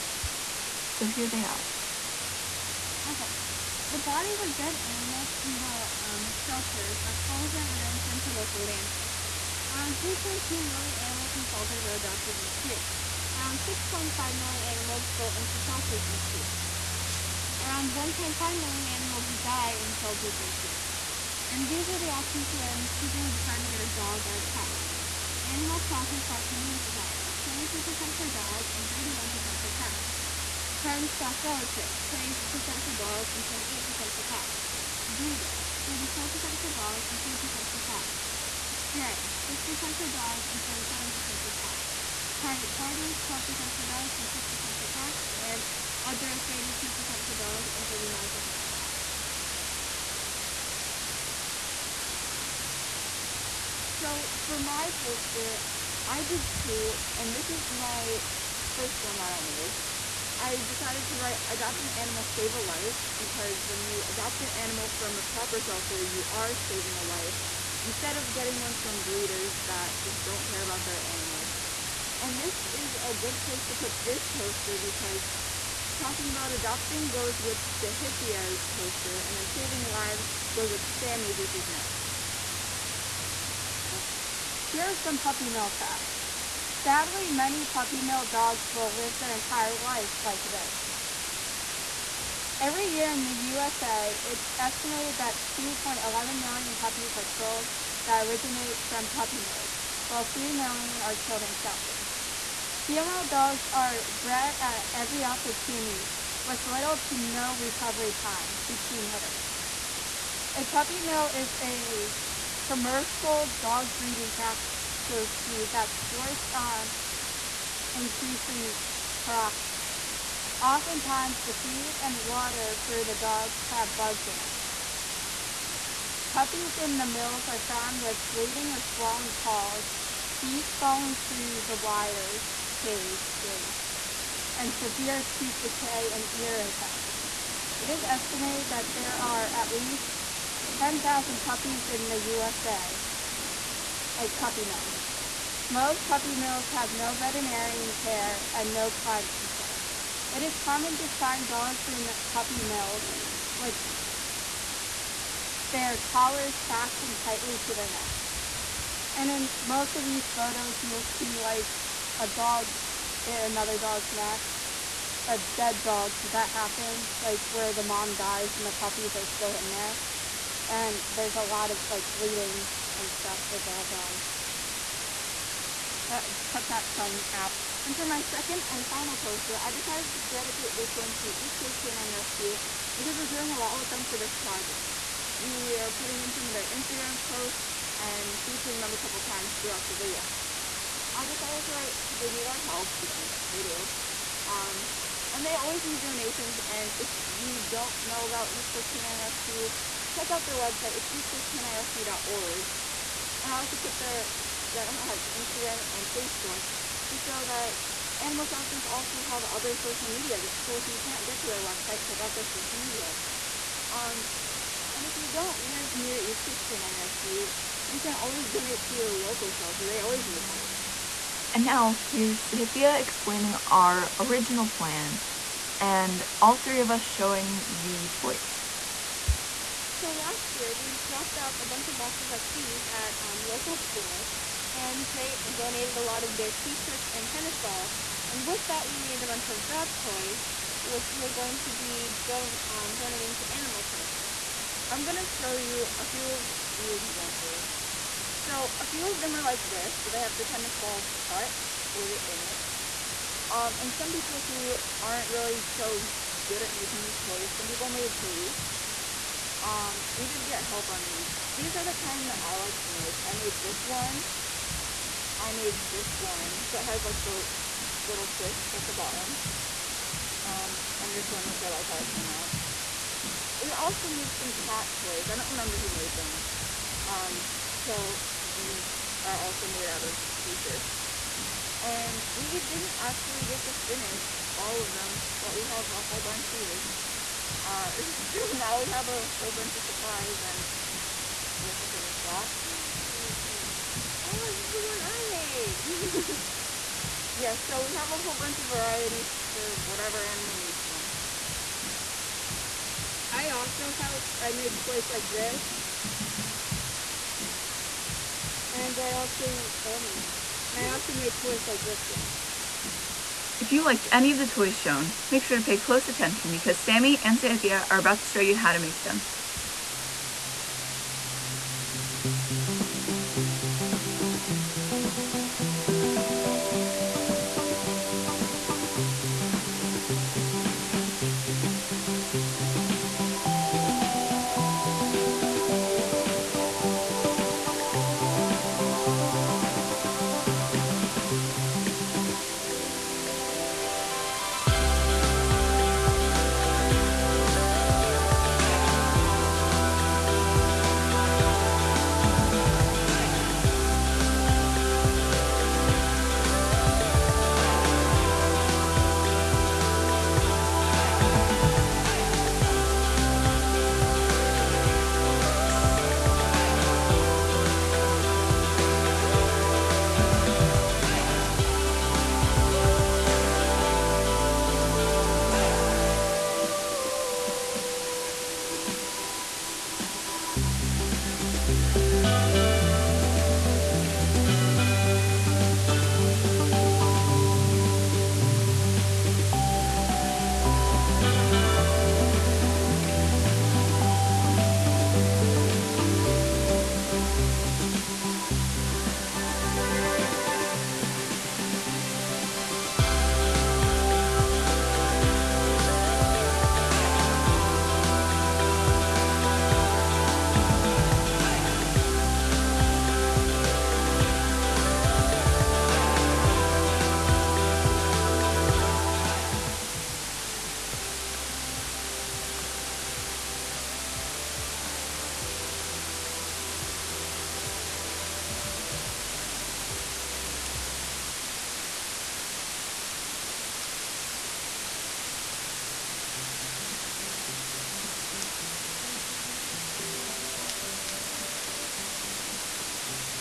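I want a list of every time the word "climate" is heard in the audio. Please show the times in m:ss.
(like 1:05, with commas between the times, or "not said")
2:28.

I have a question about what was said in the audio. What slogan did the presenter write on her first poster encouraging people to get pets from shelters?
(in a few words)
Adopt an animal, save a life.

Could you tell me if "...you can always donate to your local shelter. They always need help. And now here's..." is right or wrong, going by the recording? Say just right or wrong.
right.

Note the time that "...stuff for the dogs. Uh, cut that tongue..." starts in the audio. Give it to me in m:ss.
2:53.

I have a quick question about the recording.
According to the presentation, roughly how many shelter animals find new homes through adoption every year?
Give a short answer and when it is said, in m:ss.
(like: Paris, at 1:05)
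3.2 million, at 0:09.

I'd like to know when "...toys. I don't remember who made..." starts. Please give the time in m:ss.
4:35.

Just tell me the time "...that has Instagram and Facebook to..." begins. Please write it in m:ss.
3:24.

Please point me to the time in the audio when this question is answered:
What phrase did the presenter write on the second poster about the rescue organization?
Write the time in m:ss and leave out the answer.
3:12.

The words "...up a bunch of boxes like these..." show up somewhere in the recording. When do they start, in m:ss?
3:51.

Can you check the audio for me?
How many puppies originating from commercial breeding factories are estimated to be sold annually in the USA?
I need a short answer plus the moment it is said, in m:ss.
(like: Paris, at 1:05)
2.11 million, at 1:35.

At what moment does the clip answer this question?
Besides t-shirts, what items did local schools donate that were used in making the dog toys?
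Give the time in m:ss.
3:57.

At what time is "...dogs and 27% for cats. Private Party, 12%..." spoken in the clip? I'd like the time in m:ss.
0:40.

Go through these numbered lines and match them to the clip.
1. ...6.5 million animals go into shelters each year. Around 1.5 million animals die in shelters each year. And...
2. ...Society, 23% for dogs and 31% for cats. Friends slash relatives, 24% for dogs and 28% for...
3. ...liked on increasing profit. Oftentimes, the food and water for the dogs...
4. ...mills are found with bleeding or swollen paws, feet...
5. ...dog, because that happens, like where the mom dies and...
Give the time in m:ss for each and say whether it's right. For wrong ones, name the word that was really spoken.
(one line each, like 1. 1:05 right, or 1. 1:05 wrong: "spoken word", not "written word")
1. 0:13 right
2. 0:26 wrong: "20", not "24"
3. 1:56 wrong: "forced", not "liked"
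4. 2:07 right
5. 2:45 right.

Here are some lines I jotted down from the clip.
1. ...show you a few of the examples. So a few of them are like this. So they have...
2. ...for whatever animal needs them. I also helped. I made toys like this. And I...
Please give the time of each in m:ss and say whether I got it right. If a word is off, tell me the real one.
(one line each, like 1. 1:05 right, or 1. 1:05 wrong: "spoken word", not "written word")
1. 4:05 right
2. 4:59 right.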